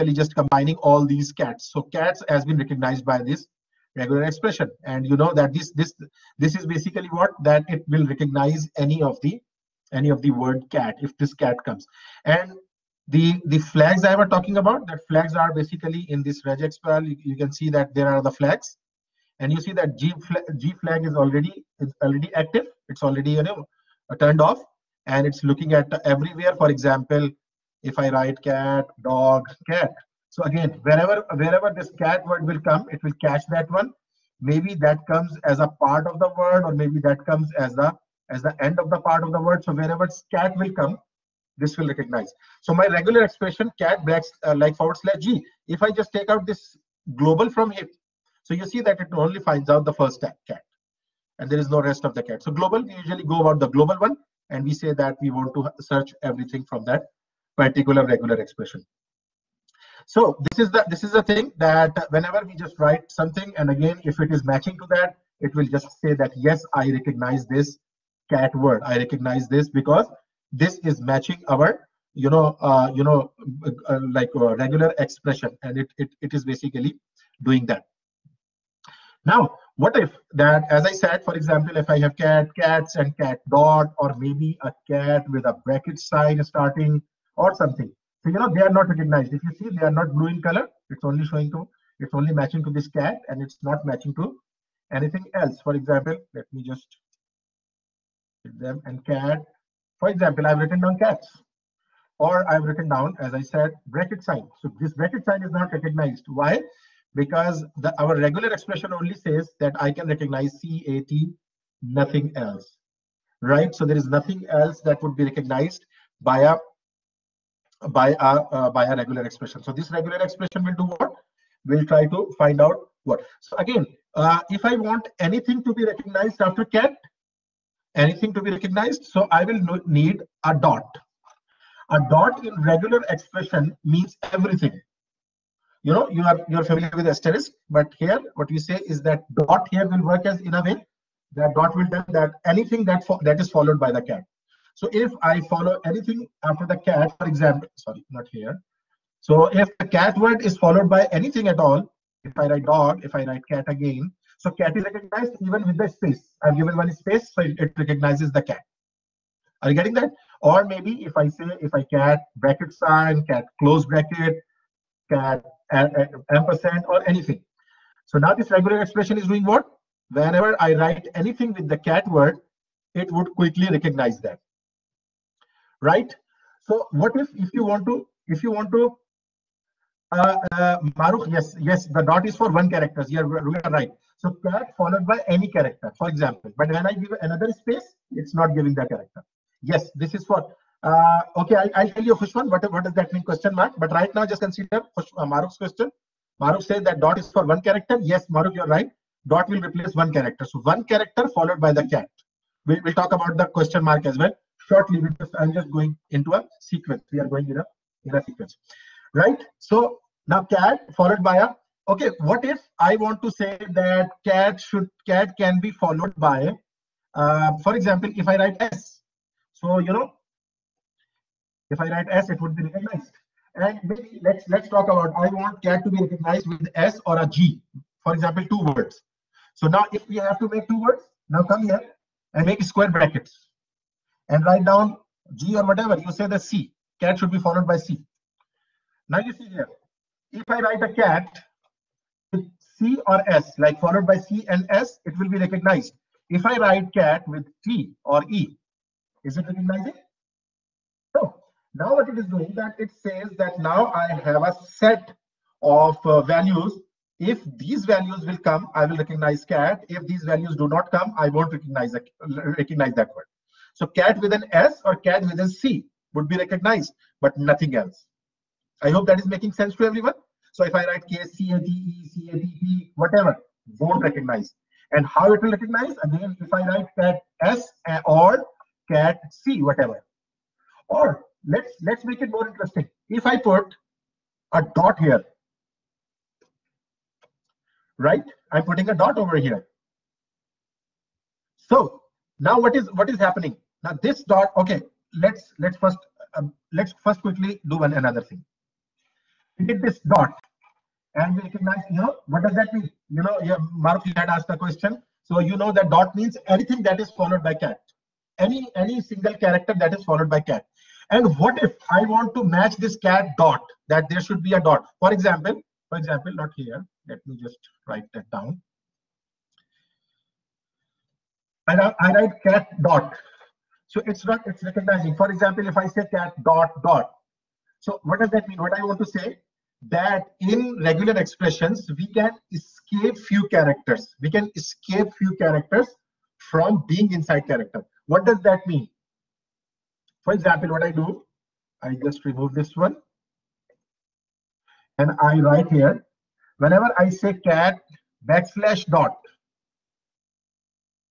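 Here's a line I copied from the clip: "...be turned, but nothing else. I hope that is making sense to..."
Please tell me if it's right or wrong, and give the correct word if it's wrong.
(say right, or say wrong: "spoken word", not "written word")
wrong: "recognized", not "turned".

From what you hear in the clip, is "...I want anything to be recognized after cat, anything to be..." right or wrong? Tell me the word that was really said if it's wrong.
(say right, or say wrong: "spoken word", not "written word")
right.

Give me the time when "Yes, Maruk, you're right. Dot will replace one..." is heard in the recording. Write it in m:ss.
3:18.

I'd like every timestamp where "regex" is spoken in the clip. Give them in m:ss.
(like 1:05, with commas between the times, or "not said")
0:16.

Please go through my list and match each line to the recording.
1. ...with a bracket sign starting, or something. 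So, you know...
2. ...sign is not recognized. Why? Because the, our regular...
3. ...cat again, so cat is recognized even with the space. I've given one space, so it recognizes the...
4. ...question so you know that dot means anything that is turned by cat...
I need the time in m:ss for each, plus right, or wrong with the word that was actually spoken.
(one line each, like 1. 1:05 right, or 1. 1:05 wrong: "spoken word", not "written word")
1. 1:25 right
2. 1:45 right
3. 2:33 right
4. 5:04 wrong: "followed", not "turned".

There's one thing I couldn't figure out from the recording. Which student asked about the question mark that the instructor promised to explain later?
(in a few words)
Khushwan.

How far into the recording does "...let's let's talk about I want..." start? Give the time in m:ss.
3:44.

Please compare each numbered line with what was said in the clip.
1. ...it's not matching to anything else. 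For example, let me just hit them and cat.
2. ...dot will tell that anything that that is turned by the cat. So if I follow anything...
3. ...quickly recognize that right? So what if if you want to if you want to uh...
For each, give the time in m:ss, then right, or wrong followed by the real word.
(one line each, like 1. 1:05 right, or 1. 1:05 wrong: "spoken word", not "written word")
1. 1:33 right
2. 2:21 wrong: "followed", not "turned"
3. 2:53 right.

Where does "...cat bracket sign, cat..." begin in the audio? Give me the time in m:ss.
2:41.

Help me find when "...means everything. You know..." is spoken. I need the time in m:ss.
2:13.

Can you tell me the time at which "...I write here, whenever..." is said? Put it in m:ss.
5:45.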